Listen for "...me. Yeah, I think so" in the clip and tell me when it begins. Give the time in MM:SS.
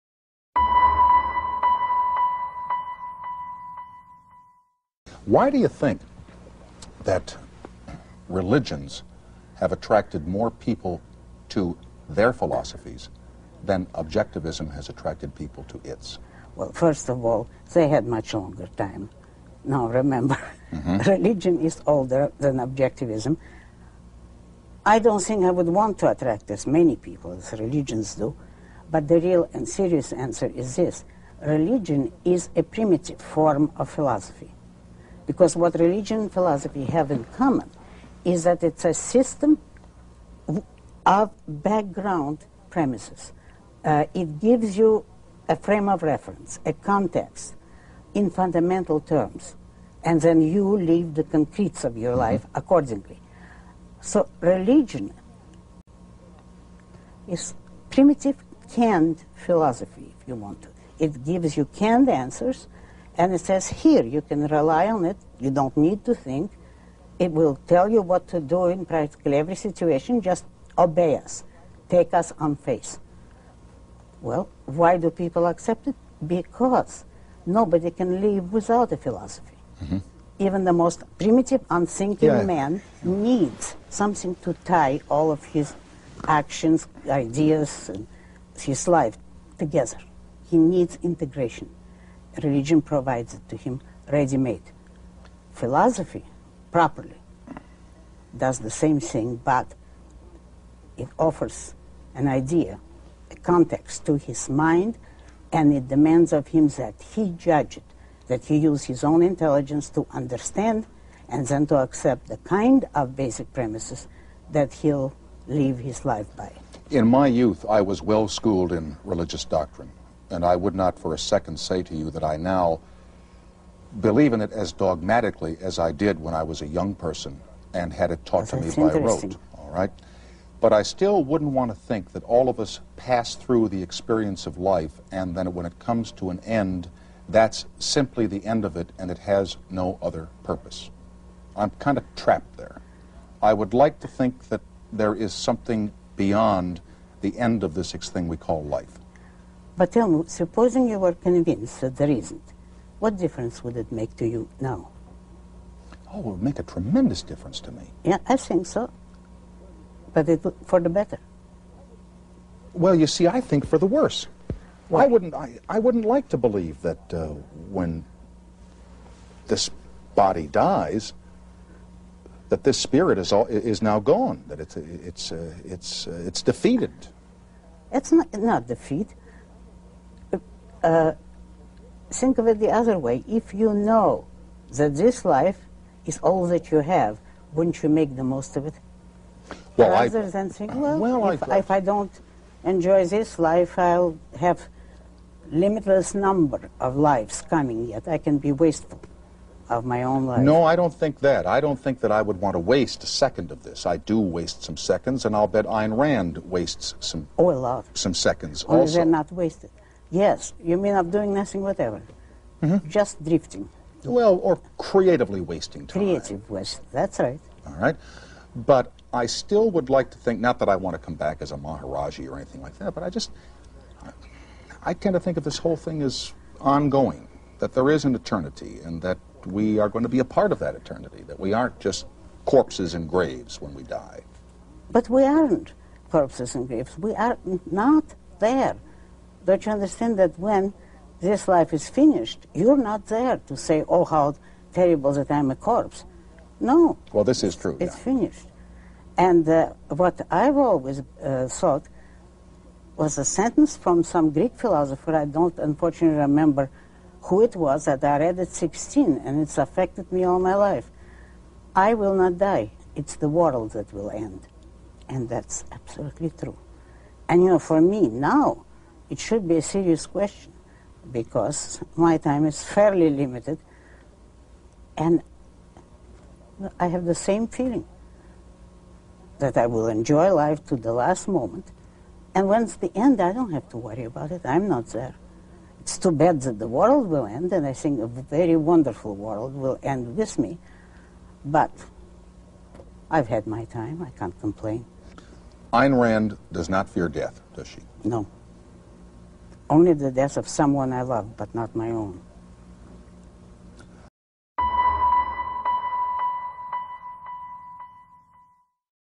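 02:37.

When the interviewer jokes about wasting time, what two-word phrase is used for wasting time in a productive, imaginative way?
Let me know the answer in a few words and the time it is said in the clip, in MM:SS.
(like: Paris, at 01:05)
Creative waste, at 03:36.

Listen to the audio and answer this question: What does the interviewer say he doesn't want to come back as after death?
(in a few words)
a Maharaji.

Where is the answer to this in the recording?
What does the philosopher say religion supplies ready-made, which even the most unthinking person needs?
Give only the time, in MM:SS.
01:31.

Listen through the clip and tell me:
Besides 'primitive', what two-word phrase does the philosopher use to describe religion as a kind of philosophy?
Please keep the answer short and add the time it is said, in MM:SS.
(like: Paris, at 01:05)
canned philosophy, at 00:58.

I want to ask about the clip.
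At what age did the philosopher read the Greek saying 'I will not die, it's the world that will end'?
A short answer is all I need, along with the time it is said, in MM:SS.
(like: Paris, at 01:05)
16, at 04:18.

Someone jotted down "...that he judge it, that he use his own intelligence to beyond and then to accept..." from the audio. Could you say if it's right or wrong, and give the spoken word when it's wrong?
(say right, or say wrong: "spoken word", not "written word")
wrong: "understand", not "beyond".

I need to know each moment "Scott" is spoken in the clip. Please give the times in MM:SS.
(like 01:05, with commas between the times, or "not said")
not said.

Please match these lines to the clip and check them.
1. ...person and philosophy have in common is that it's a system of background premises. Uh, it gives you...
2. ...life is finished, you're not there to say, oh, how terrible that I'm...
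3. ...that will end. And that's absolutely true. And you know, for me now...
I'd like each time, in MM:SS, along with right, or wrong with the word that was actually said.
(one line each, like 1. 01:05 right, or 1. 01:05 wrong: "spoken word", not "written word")
1. 00:35 wrong: "religion", not "person"
2. 04:01 right
3. 04:23 right.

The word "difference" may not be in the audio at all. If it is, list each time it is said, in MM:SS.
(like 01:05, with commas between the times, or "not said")
02:33, 02:37.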